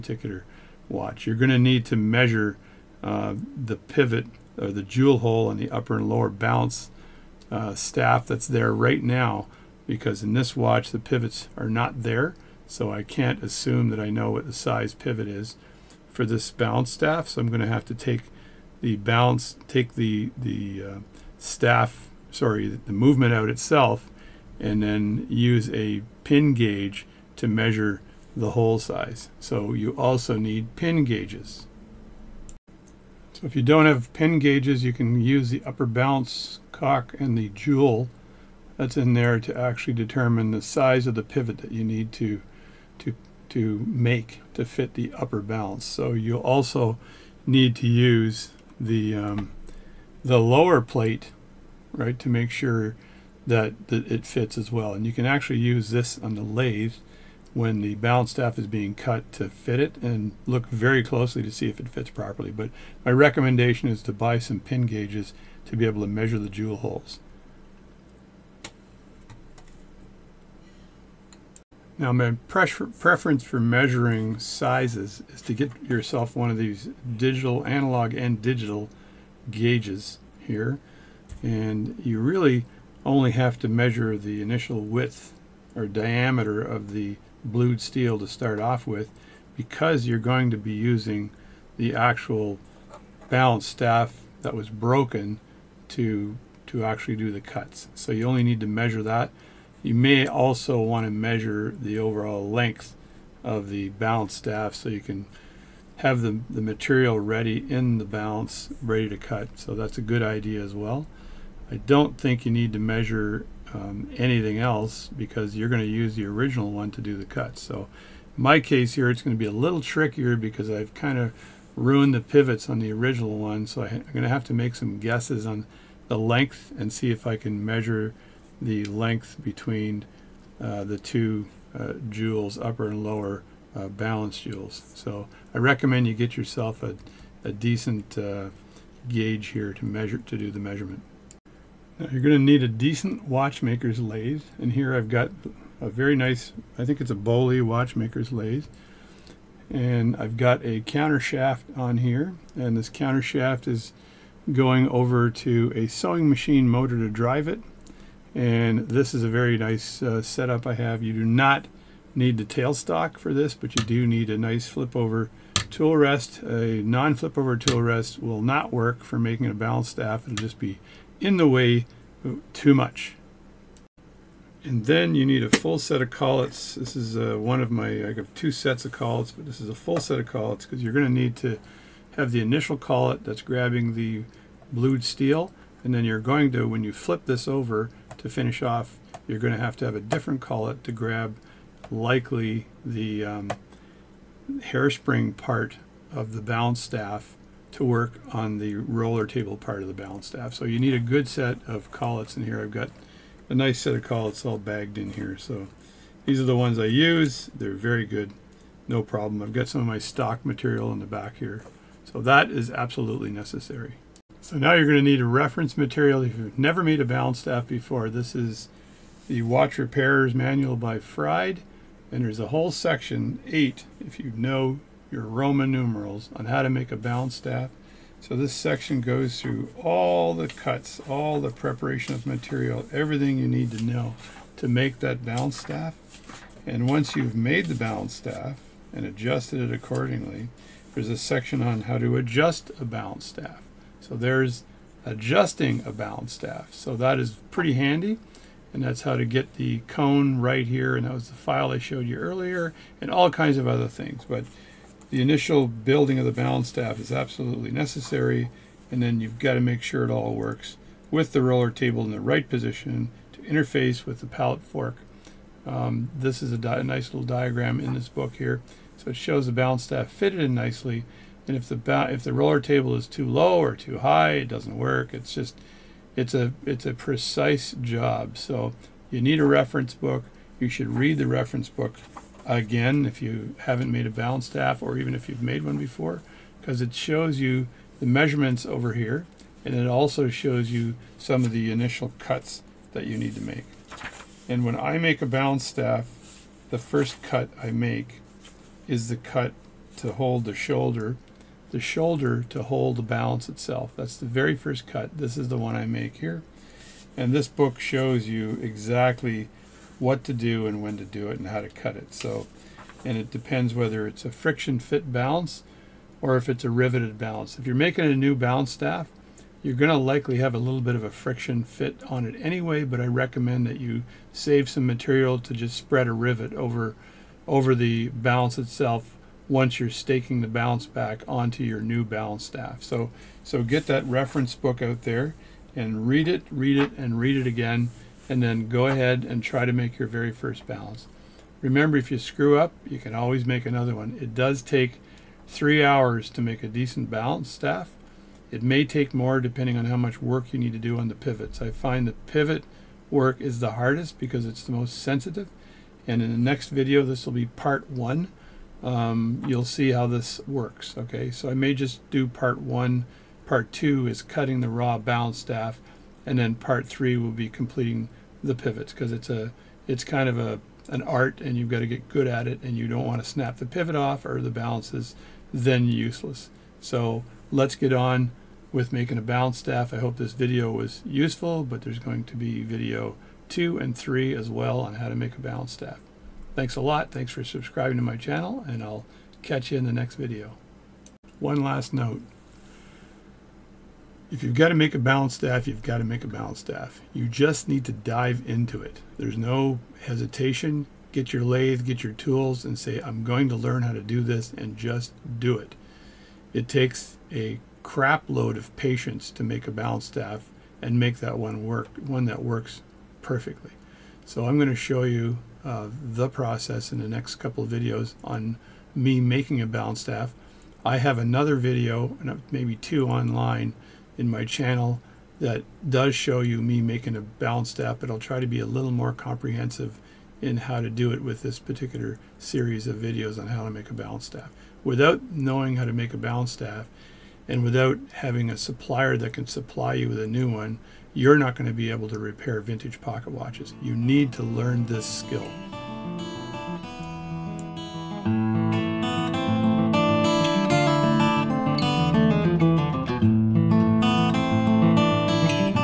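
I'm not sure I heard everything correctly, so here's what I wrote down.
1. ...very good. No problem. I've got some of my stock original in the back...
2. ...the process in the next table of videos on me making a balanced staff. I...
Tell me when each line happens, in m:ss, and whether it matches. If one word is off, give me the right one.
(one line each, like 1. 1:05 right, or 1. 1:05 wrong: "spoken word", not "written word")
1. 3:27 wrong: "material", not "original"
2. 6:56 wrong: "couple", not "table".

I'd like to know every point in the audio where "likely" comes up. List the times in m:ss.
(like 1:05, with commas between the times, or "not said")
3:11, 5:19.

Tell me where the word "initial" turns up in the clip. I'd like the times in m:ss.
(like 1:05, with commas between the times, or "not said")
1:24, 3:02, 4:15, 4:51.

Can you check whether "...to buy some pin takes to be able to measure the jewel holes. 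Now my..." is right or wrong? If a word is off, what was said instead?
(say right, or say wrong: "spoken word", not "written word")
wrong: "gauges", not "takes".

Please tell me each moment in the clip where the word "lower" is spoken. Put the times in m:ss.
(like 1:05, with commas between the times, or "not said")
0:06, 0:50, 2:13.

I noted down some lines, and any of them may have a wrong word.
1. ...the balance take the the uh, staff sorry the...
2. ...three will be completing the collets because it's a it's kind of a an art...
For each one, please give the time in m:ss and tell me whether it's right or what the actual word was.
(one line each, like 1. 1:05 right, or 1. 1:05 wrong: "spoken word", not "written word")
1. 0:18 right
2. 6:06 wrong: "pivots", not "collets".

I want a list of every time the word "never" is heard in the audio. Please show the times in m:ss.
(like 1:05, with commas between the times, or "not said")
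3:36.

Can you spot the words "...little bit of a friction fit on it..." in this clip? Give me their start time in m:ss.
5:20.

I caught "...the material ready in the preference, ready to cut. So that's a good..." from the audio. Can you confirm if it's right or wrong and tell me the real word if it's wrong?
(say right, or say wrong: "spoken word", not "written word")
wrong: "balance", not "preference".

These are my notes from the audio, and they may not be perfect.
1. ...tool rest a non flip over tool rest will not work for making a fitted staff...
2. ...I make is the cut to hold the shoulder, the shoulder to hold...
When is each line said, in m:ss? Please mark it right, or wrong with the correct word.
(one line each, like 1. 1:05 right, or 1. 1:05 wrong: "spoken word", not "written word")
1. 2:45 wrong: "balanced", not "fitted"
2. 4:57 right.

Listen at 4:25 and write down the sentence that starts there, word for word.
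Um, this is a, a, nice little diagram in this book here.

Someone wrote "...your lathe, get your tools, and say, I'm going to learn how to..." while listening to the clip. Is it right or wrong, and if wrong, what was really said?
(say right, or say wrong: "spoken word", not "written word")
right.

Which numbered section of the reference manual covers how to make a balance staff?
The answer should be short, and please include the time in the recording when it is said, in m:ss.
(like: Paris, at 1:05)
8, at 3:43.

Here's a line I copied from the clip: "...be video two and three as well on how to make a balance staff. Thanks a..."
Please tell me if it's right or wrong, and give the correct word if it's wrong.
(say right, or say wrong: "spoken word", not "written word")
right.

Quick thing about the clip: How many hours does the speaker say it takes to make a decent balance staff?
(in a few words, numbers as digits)
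3.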